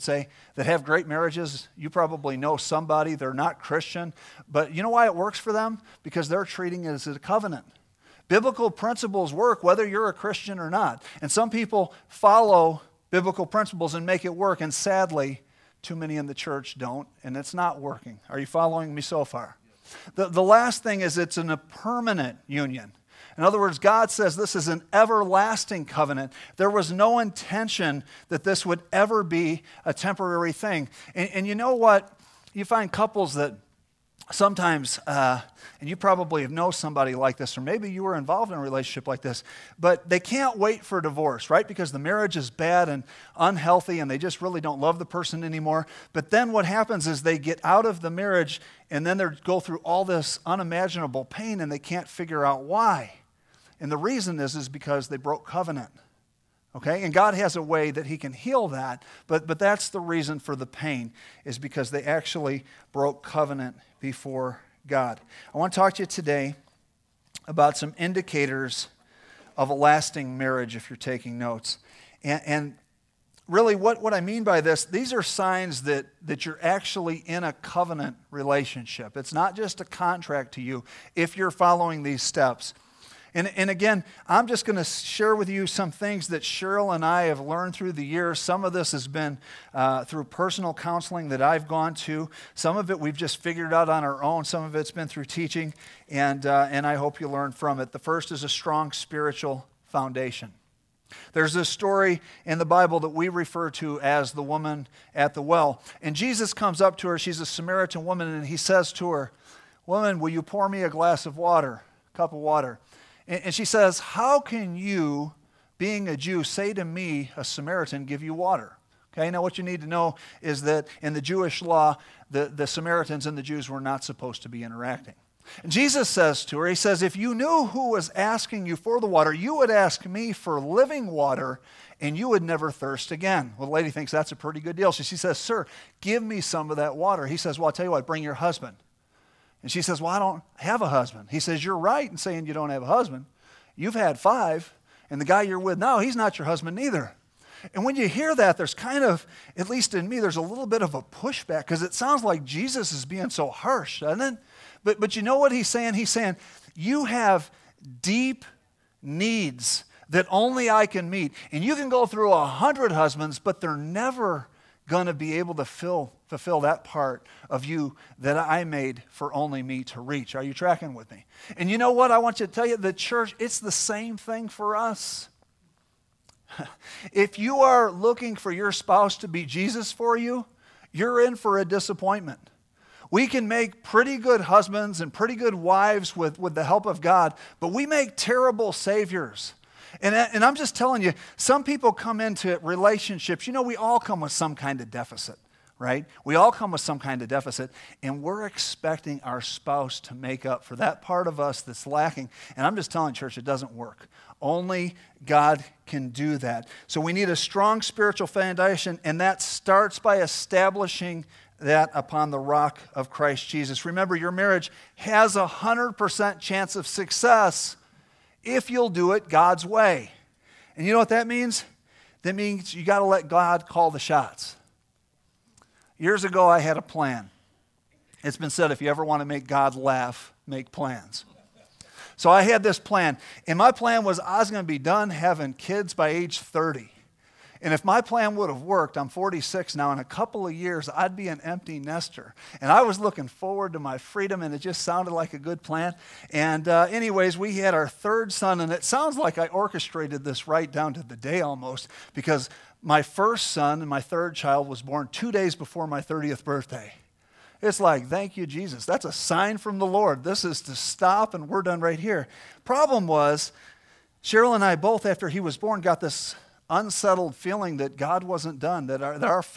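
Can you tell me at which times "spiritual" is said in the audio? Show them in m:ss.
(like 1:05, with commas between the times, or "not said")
1:38, 3:27.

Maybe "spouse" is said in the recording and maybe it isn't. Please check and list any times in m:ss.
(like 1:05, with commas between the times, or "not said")
2:58, 3:19.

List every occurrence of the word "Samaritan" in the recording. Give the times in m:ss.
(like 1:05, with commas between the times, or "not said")
1:47, 1:57, 2:02.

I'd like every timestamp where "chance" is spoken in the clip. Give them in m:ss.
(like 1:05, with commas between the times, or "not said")
3:36.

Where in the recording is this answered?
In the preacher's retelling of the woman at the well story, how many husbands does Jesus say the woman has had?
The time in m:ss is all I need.
2:23.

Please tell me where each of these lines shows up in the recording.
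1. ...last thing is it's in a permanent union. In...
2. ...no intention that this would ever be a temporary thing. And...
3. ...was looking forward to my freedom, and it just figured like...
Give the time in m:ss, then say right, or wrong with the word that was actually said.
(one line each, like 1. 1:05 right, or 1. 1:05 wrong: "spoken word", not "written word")
1. 0:20 right
2. 0:26 right
3. 4:02 wrong: "sounded", not "figured".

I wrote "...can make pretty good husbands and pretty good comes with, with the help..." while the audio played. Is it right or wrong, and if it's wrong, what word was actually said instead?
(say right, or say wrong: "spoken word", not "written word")
wrong: "wives", not "comes".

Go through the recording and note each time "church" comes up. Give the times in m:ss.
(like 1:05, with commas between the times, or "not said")
0:16, 2:52, 3:23.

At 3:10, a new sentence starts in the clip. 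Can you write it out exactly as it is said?
And, and I'm just telling you, some people come into relationships, you know, we all come with some kind of deficit right?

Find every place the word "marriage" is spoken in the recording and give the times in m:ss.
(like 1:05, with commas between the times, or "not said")
0:01, 0:41, 0:48, 1:10, 3:34.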